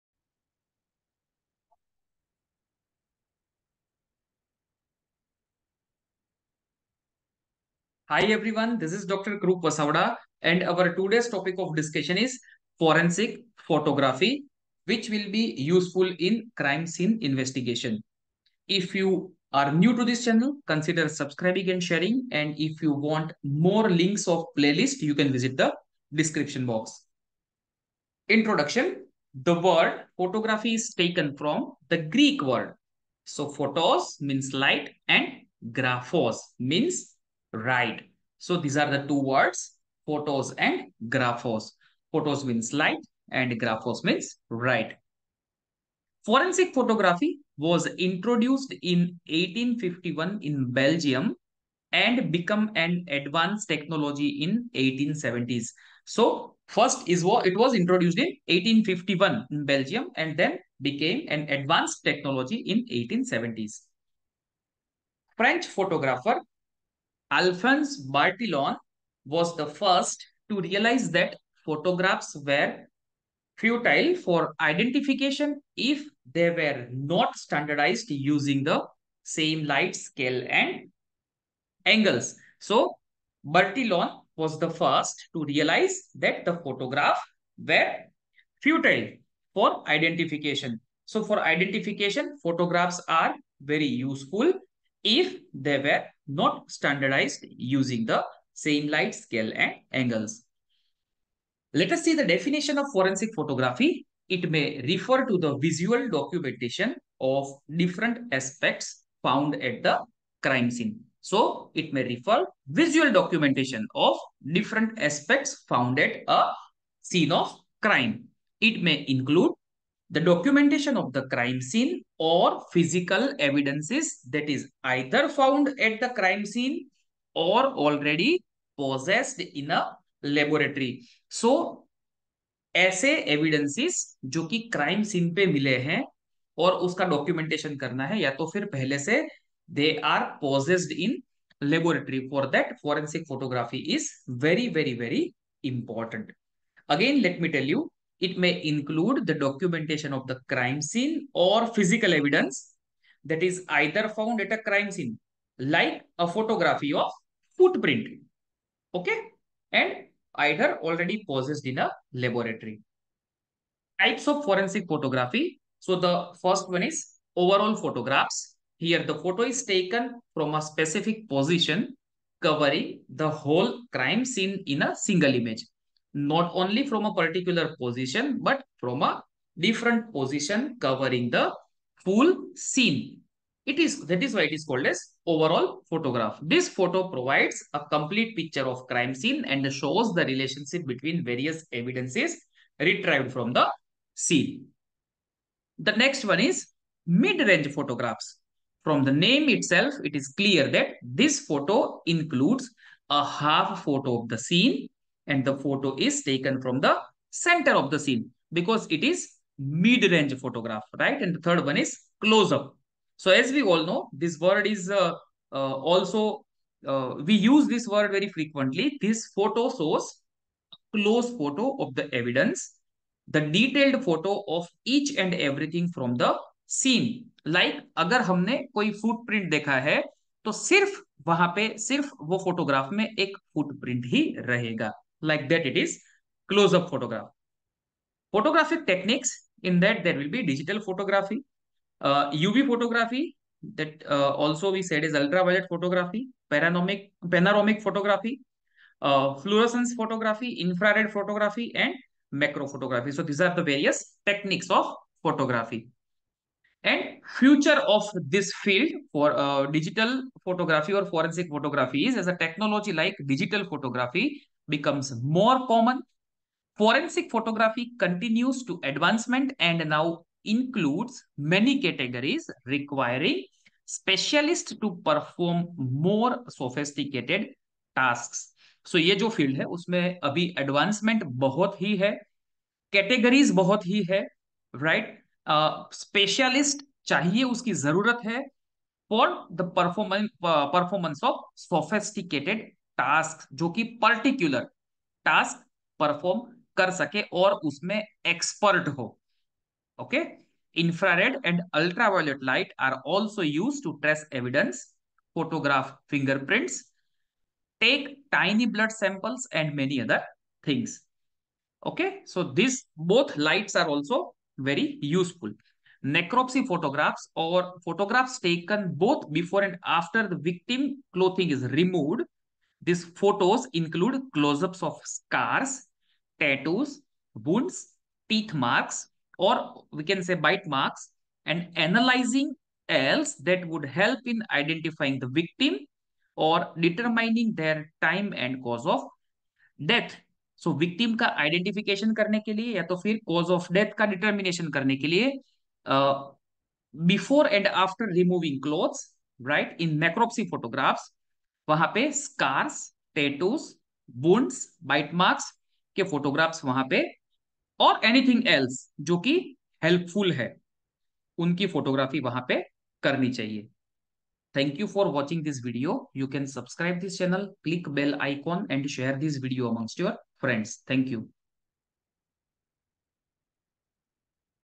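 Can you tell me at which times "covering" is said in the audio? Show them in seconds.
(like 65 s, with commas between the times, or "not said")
172 s, 180 s.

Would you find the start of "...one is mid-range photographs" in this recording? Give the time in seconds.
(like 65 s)
196 s.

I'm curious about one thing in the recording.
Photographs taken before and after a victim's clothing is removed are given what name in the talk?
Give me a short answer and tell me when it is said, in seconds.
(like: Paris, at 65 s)
Necropsy photographs, at 316 s.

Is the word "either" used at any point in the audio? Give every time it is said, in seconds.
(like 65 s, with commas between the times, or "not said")
124 s, 153 s, 160 s.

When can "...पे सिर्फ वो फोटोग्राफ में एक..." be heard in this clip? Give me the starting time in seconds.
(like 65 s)
231 s.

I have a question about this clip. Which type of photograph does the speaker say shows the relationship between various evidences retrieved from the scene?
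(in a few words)
Overall photographs.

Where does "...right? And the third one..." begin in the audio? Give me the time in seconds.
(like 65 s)
210 s.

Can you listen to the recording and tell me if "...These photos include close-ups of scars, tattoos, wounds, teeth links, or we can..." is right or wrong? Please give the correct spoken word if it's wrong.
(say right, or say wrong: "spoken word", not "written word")
wrong: "marks", not "links".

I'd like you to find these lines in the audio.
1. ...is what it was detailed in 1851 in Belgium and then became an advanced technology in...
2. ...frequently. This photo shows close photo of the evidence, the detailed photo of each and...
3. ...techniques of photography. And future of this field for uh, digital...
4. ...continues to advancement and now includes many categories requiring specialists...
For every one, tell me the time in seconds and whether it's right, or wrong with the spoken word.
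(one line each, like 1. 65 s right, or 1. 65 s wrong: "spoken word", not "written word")
1. 57 s wrong: "introduced", not "detailed"
2. 218 s right
3. 254 s right
4. 267 s right.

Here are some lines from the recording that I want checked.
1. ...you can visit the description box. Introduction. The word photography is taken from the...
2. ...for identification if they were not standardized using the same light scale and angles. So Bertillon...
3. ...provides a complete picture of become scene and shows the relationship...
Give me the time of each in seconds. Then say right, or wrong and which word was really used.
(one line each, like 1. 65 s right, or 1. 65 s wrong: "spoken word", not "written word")
1. 25 s right
2. 74 s right
3. 187 s wrong: "crime", not "become".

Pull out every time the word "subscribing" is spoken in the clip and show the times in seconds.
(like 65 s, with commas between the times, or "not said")
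21 s.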